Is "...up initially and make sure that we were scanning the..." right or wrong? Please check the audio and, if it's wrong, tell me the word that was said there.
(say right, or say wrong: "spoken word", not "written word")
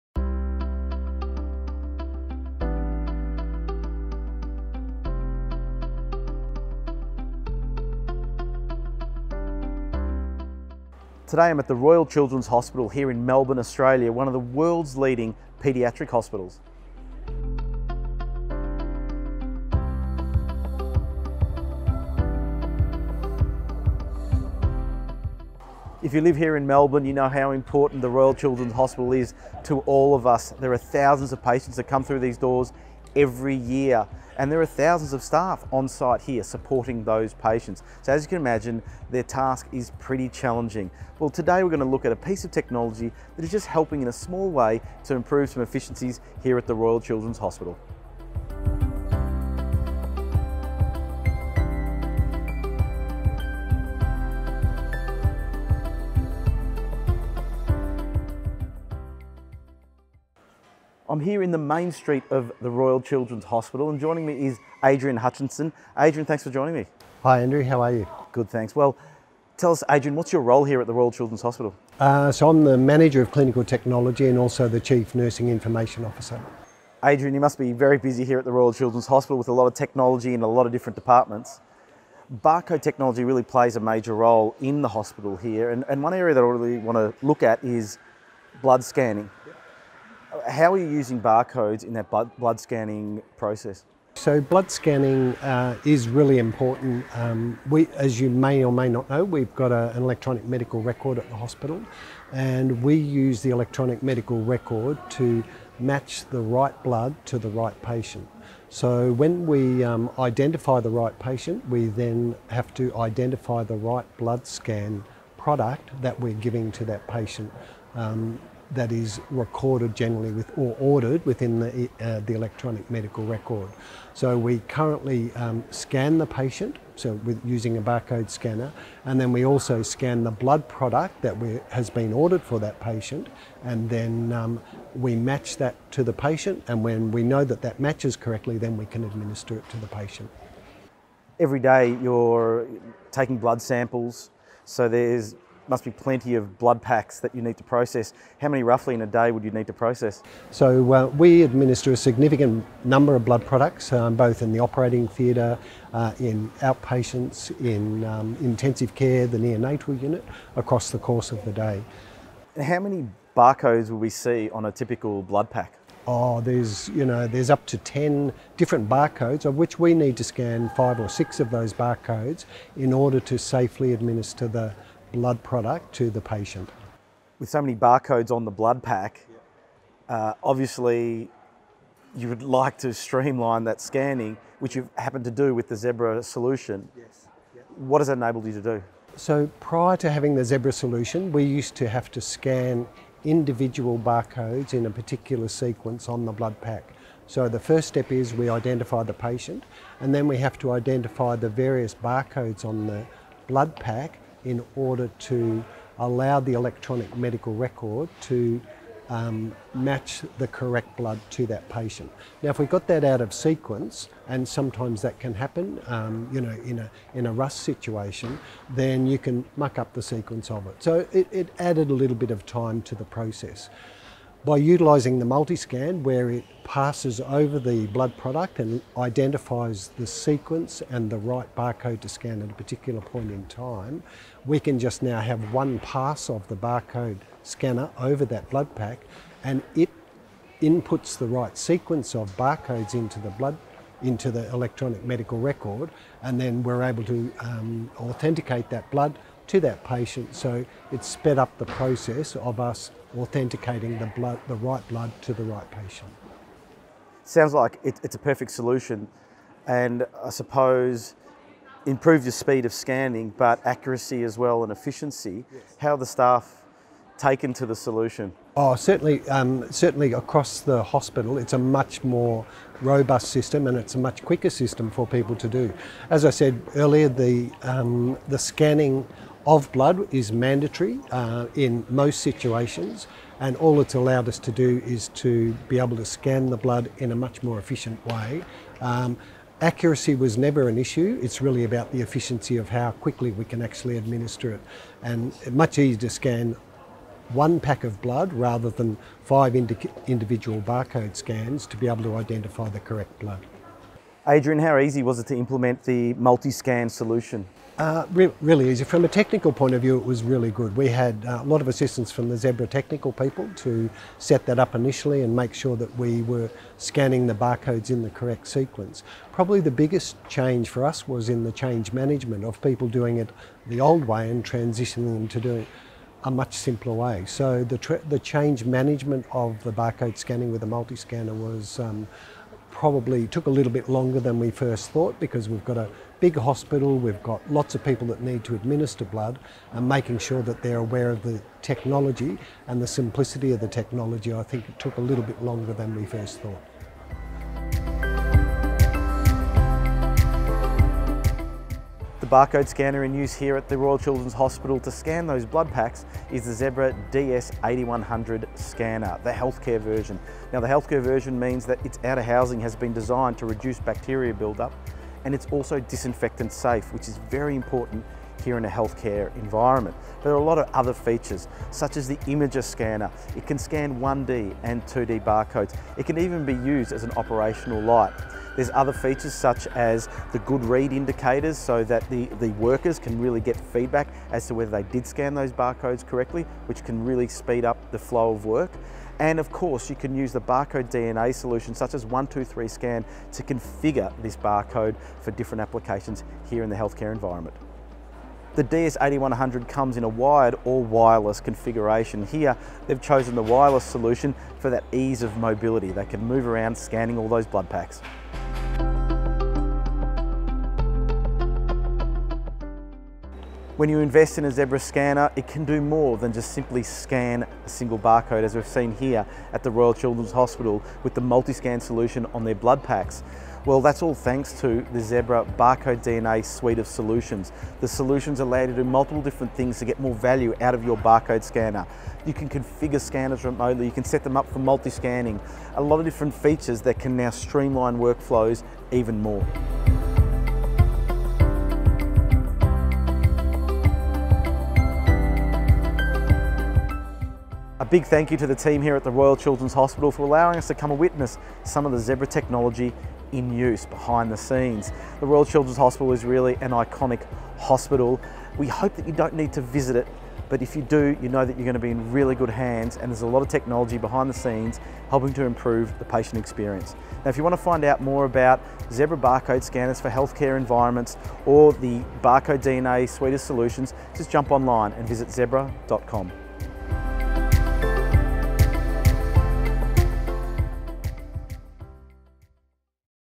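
right.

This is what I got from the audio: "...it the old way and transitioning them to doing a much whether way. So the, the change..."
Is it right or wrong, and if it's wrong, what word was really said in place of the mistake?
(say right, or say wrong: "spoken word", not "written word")
wrong: "simpler", not "whether".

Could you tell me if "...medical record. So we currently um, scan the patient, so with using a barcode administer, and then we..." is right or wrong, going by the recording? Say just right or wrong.
wrong.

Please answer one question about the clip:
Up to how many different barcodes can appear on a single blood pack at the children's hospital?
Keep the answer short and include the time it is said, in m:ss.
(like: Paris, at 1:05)
10, at 2:47.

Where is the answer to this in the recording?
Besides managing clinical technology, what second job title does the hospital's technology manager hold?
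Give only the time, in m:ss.
1:14.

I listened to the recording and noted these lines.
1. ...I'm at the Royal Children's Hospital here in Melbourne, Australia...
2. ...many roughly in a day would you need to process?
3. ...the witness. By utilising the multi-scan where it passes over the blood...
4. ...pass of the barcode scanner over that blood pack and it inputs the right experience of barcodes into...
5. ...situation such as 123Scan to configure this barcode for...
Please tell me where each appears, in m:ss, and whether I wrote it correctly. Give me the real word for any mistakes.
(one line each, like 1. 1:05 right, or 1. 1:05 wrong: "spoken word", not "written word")
1. 0:11 right
2. 2:28 right
3. 3:42 wrong: "process", not "witness"
4. 3:55 wrong: "sequence", not "experience"
5. 6:31 wrong: "solution", not "situation".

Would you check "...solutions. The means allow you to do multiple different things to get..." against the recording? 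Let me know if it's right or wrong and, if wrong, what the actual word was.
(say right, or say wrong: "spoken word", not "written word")
wrong: "solutions", not "means".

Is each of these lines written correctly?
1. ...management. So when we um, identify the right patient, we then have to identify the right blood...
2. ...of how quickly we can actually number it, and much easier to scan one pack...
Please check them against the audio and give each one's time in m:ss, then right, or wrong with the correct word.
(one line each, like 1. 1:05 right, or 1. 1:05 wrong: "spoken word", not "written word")
1. 1:47 wrong: "patient", not "management"
2. 4:52 wrong: "administer", not "number".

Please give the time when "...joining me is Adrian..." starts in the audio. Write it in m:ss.
1:03.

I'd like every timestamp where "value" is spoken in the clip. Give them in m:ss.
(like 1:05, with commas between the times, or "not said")
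7:10.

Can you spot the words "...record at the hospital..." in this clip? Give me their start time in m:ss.
1:40.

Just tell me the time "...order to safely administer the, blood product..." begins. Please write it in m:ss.
2:52.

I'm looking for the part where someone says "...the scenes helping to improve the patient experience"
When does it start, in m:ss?
7:44.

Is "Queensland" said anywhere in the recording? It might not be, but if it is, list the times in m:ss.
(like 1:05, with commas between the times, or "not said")
not said.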